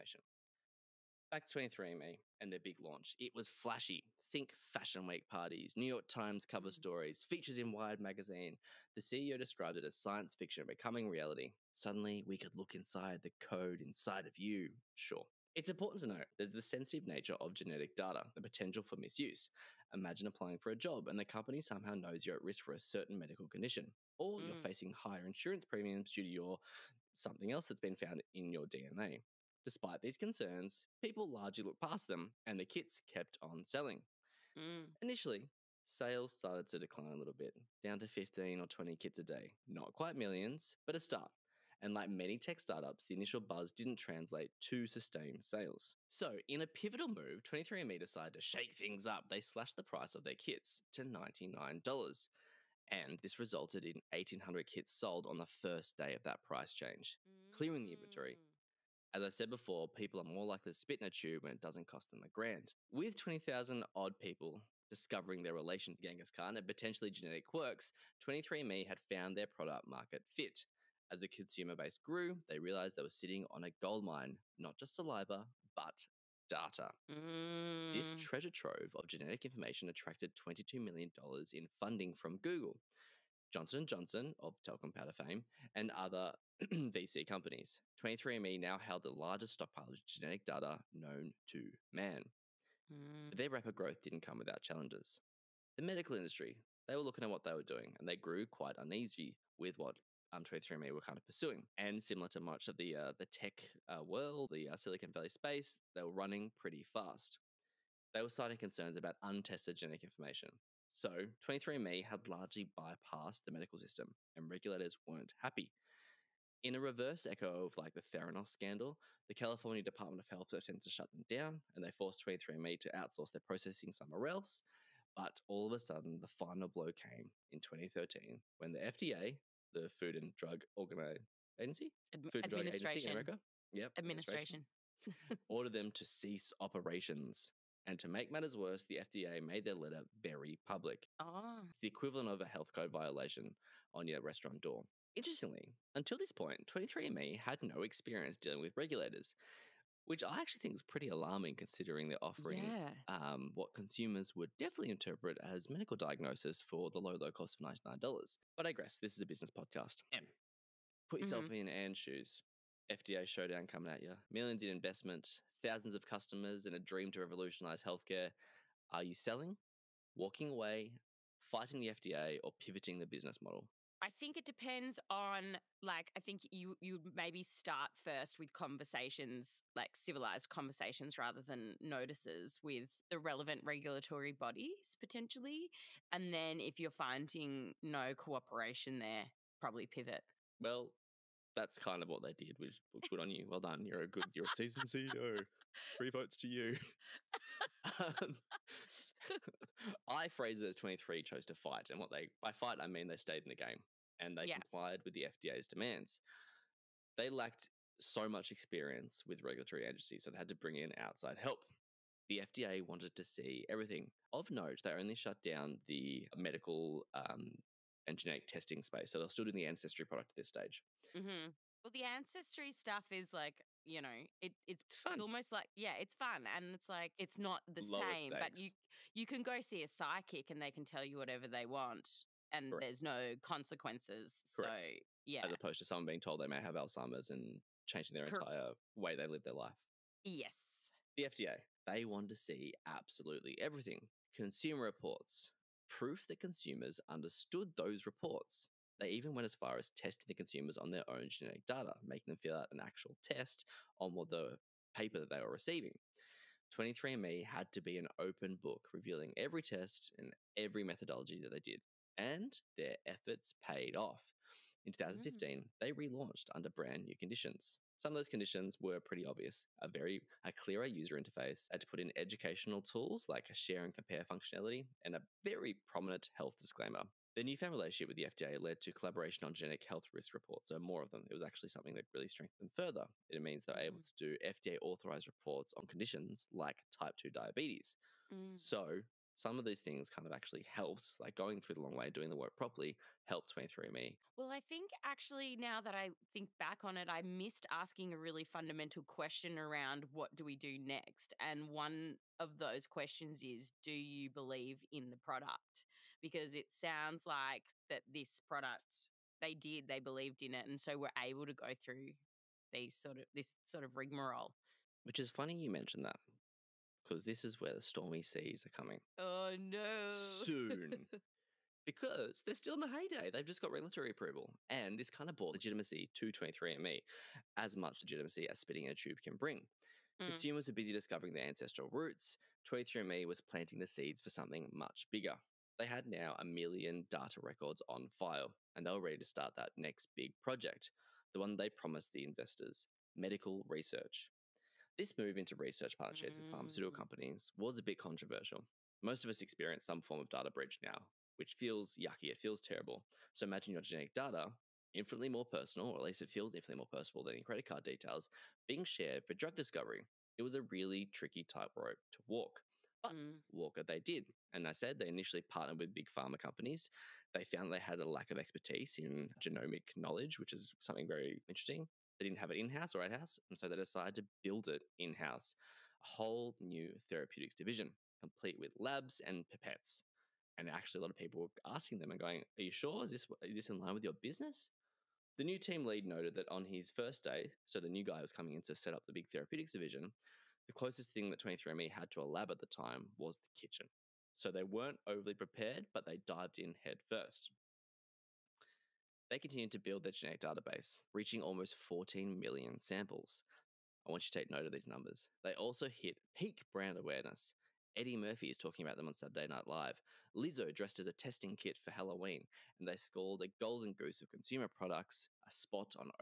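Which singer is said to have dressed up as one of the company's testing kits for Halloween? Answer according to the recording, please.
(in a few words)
Lizzo.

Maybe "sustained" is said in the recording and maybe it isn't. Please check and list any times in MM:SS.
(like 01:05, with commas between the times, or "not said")
00:44.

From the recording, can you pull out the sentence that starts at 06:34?
So they weren't overly prepared, but they dived in headfirst.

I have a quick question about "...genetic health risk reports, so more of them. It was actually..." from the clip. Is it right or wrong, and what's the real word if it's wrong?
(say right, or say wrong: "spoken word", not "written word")
right.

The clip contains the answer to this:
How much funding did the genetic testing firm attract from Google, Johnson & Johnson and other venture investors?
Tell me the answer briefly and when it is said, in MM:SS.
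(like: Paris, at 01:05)
$22 million, at 01:20.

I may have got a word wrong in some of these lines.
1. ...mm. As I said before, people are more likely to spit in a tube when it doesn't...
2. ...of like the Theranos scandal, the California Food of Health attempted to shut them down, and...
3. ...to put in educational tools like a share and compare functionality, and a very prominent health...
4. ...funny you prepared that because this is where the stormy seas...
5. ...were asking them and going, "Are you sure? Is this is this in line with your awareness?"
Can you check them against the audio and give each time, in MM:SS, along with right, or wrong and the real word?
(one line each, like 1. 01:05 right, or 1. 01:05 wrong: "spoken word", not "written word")
1. 00:58 right
2. 01:57 wrong: "Department", not "Food"
3. 04:31 right
4. 05:15 wrong: "mentioned", not "prepared"
5. 06:21 wrong: "business", not "awareness".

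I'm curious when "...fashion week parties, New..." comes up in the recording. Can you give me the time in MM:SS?
00:04.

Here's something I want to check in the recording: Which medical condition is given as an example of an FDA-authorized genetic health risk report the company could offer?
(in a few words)
type 2 diabetes.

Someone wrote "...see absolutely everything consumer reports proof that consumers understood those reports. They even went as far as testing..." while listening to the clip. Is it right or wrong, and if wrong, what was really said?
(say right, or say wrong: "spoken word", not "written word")
right.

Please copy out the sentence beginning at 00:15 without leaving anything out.
It's important to note there's the sensitive nature of genetic data, the potential for misuse.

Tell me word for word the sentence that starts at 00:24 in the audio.
you're facing higher insurance premiums due to your something else that's been found in your DNA.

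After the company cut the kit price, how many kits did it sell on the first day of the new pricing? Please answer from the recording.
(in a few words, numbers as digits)
1,800.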